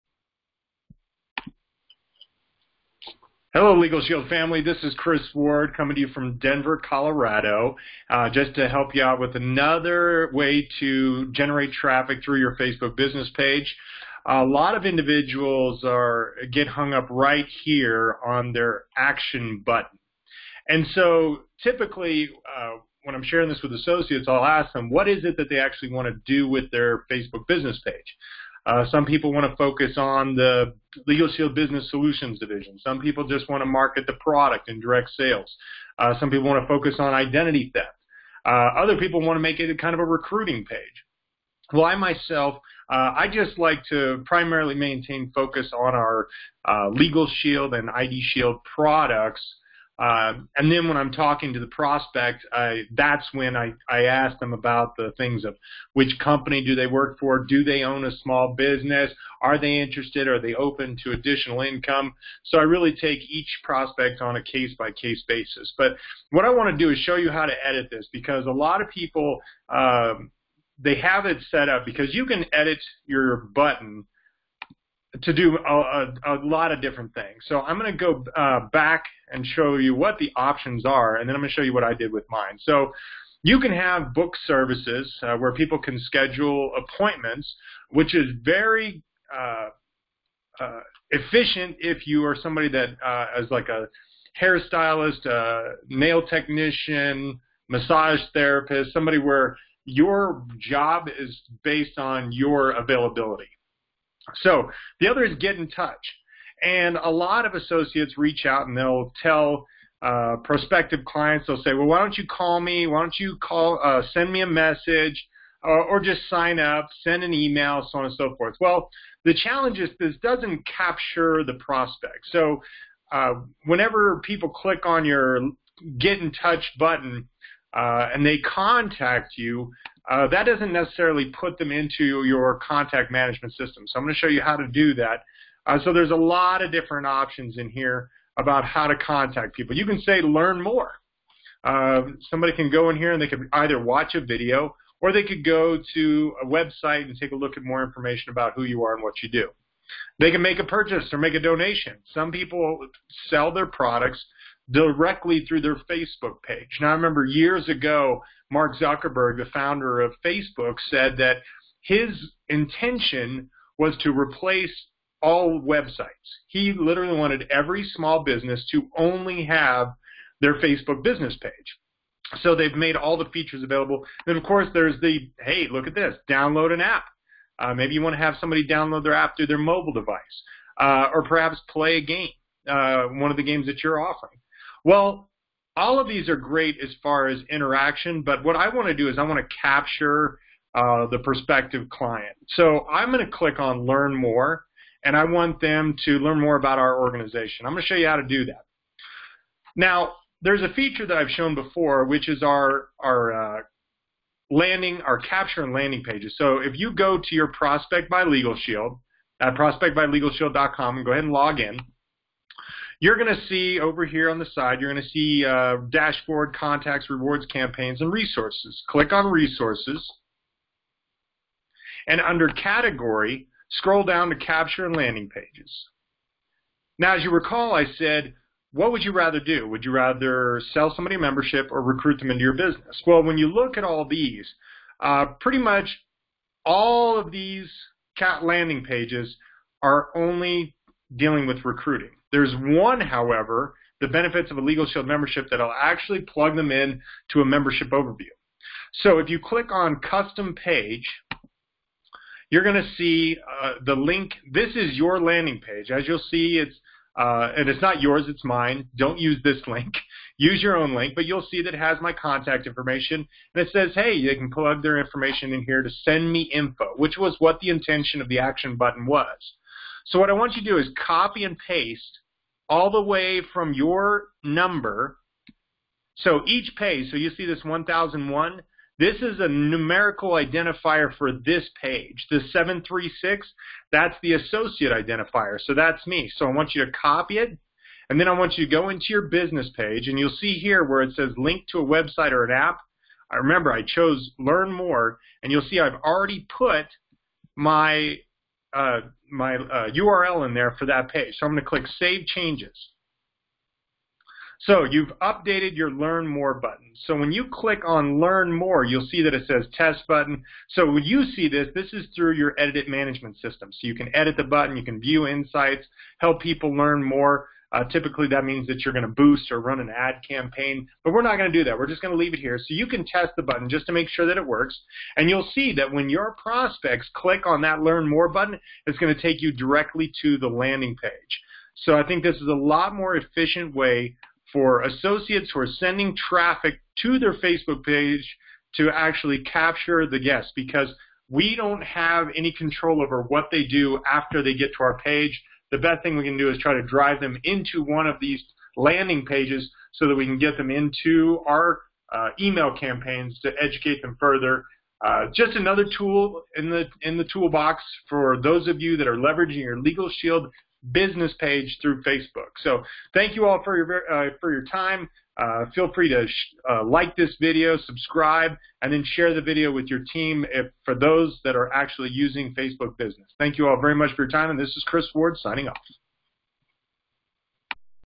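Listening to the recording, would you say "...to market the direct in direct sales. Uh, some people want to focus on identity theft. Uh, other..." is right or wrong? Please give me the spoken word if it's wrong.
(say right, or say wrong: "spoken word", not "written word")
wrong: "product", not "direct".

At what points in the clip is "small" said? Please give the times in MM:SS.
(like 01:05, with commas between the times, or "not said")
00:58, 02:47.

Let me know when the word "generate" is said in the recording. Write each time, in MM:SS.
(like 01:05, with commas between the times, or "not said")
00:11.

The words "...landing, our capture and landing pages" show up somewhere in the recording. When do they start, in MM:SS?
03:24.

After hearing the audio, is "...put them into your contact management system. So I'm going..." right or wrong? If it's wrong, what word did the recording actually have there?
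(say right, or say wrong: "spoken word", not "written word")
right.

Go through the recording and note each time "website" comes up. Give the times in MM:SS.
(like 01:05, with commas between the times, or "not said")
02:26, 02:45, 04:51.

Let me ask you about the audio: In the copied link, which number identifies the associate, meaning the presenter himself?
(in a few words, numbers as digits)
736.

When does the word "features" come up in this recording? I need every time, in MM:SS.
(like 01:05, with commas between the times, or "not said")
02:53, 03:20.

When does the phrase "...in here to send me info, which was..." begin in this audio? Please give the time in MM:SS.
04:25.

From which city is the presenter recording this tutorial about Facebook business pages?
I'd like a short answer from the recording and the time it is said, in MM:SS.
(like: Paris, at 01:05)
Denver, at 00:06.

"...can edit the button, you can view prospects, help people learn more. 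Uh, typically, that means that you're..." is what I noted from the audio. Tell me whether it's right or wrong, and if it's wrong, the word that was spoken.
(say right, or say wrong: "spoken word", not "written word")
wrong: "insights", not "prospects".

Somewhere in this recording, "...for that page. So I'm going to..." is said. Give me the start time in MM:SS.
05:00.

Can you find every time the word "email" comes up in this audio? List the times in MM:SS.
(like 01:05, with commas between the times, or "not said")
01:57, 05:52.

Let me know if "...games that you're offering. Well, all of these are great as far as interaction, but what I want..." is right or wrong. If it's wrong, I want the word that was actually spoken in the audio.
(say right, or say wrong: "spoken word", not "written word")
right.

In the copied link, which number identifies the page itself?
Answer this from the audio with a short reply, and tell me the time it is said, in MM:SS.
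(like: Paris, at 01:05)
1001, at 04:37.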